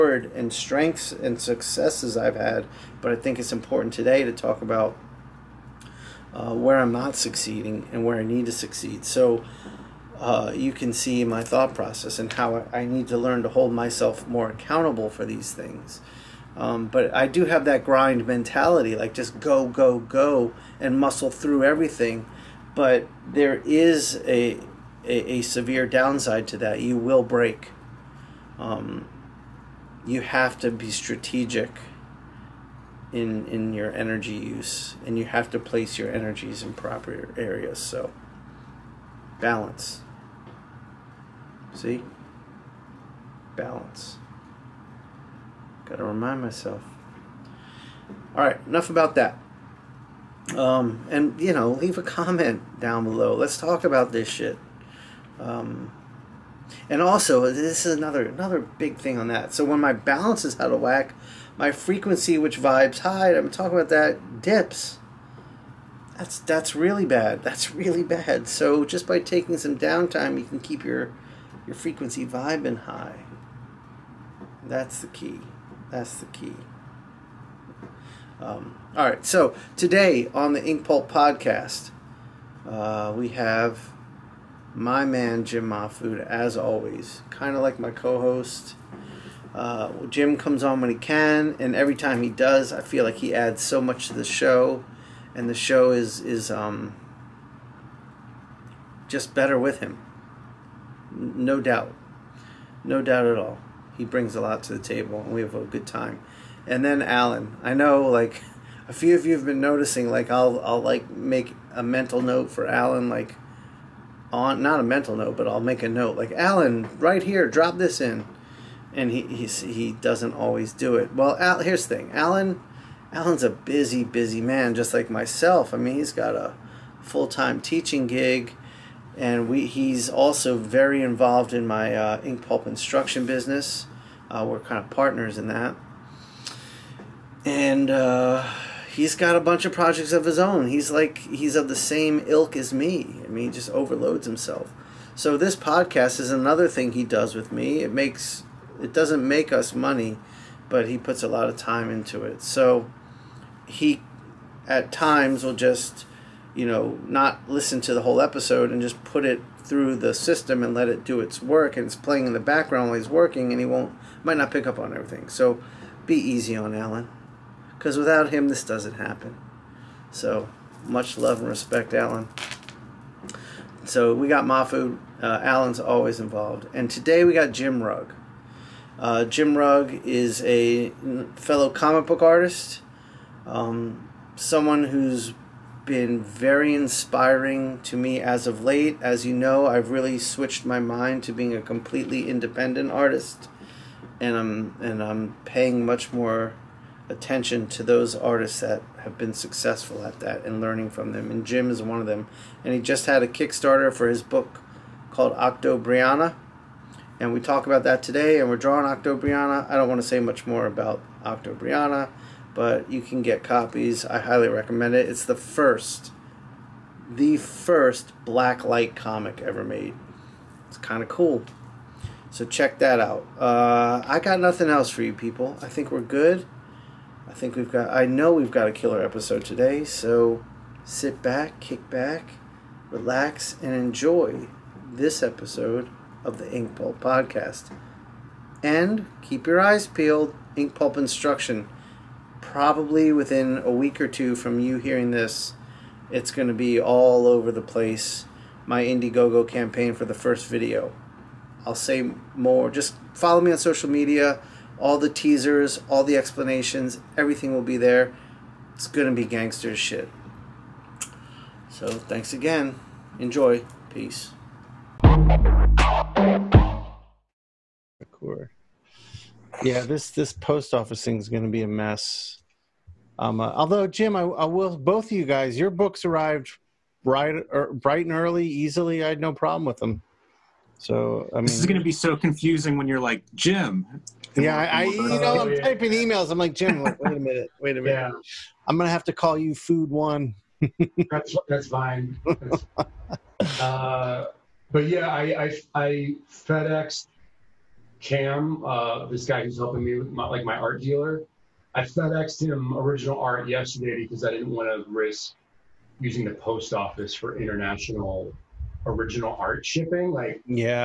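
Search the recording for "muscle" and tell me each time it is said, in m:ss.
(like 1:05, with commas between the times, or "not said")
0:20.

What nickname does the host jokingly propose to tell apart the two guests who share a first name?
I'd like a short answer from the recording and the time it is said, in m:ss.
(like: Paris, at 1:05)
Food One, at 4:49.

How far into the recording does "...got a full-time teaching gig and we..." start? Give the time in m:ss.
2:06.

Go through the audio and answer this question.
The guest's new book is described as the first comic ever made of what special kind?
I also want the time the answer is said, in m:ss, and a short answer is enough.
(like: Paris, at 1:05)
black light comic, at 3:38.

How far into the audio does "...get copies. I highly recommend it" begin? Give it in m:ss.
3:33.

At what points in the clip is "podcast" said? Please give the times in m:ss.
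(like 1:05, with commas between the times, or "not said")
1:21, 2:25, 3:56.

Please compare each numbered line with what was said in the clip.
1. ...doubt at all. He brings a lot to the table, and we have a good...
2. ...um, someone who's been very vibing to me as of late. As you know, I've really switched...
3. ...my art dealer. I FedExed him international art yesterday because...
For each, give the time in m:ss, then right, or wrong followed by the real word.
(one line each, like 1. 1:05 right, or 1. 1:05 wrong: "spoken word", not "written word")
1. 1:43 right
2. 3:03 wrong: "inspiring", not "vibing"
3. 5:00 wrong: "original", not "international".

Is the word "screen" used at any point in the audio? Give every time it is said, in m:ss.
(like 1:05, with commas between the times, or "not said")
not said.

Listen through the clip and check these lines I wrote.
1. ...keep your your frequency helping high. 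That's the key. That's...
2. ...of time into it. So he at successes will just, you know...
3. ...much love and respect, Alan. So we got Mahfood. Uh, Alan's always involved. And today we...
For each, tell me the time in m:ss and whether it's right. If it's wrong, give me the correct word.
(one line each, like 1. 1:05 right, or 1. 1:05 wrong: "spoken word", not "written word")
1. 1:10 wrong: "vibing", not "helping"
2. 2:31 wrong: "times", not "successes"
3. 2:50 right.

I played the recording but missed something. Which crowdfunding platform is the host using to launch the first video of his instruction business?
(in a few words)
Indiegogo.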